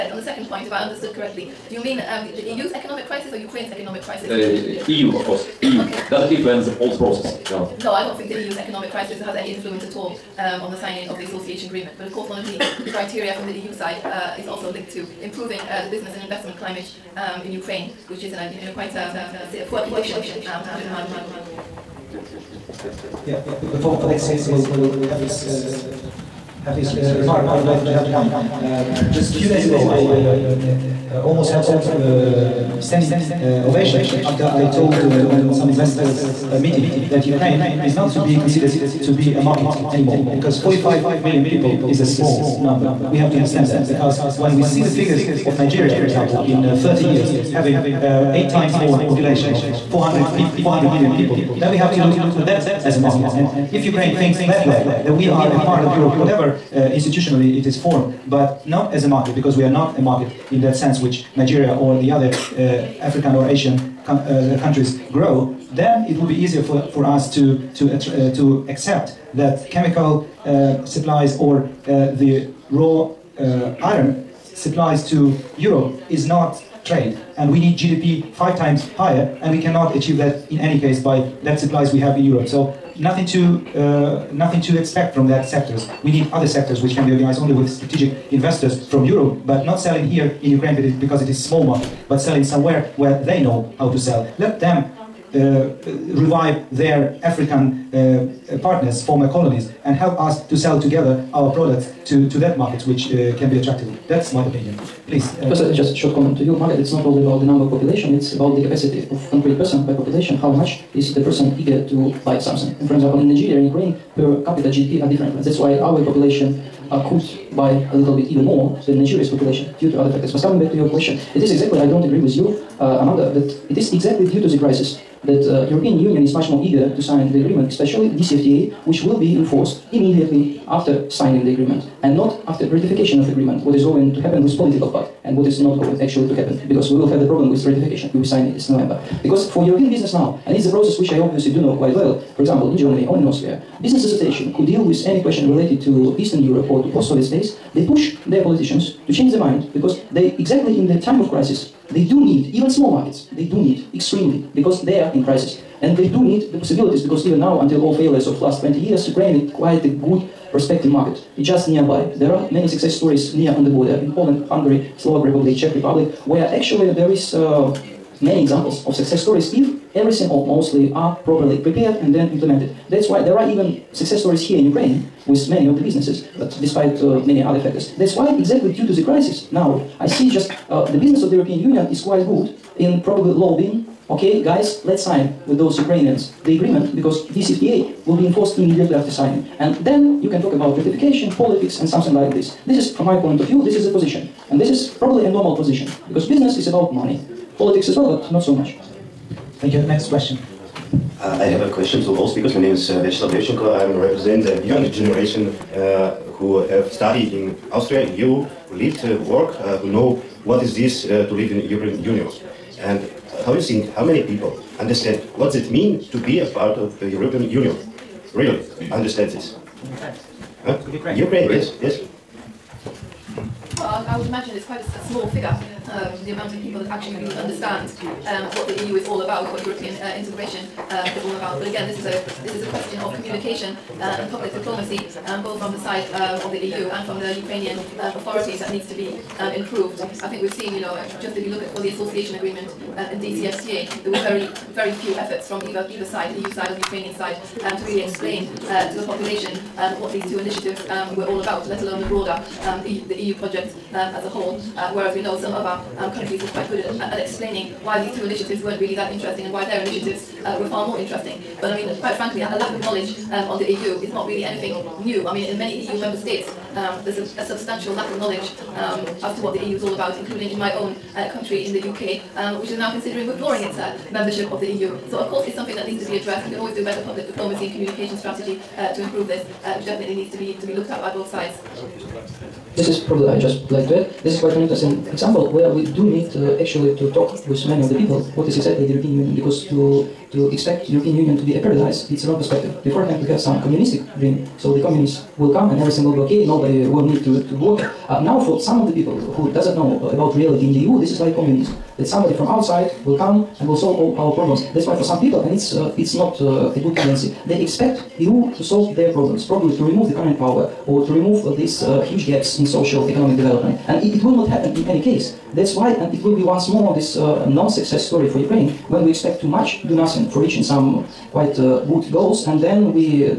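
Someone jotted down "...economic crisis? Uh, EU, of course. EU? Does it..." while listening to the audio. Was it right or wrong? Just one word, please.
right.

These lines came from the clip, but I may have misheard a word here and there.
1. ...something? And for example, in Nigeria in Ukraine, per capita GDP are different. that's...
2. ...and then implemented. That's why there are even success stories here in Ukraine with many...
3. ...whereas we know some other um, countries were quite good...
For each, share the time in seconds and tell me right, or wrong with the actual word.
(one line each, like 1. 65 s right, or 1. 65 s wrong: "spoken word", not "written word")
1. 112 s right
2. 172 s right
3. 254 s right.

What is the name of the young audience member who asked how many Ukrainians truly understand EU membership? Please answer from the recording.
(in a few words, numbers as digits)
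Vyacheslav Levchenko.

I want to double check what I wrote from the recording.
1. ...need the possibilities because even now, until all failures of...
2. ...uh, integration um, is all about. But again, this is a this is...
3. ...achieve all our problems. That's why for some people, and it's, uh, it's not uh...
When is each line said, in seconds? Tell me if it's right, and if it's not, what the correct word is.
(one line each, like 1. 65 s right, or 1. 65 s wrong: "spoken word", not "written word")
1. 156 s right
2. 229 s right
3. 303 s wrong: "solve", not "achieve".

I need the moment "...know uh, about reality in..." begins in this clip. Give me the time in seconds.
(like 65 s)
299 s.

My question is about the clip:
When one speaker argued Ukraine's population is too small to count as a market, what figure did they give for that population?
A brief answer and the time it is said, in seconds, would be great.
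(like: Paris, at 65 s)
45 million, at 40 s.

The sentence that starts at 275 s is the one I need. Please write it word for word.
So of course it's something that needs to be addressed.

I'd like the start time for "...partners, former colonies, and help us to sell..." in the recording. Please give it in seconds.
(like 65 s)
98 s.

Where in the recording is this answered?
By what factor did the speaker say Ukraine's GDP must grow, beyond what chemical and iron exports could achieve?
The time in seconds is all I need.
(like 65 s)
78 s.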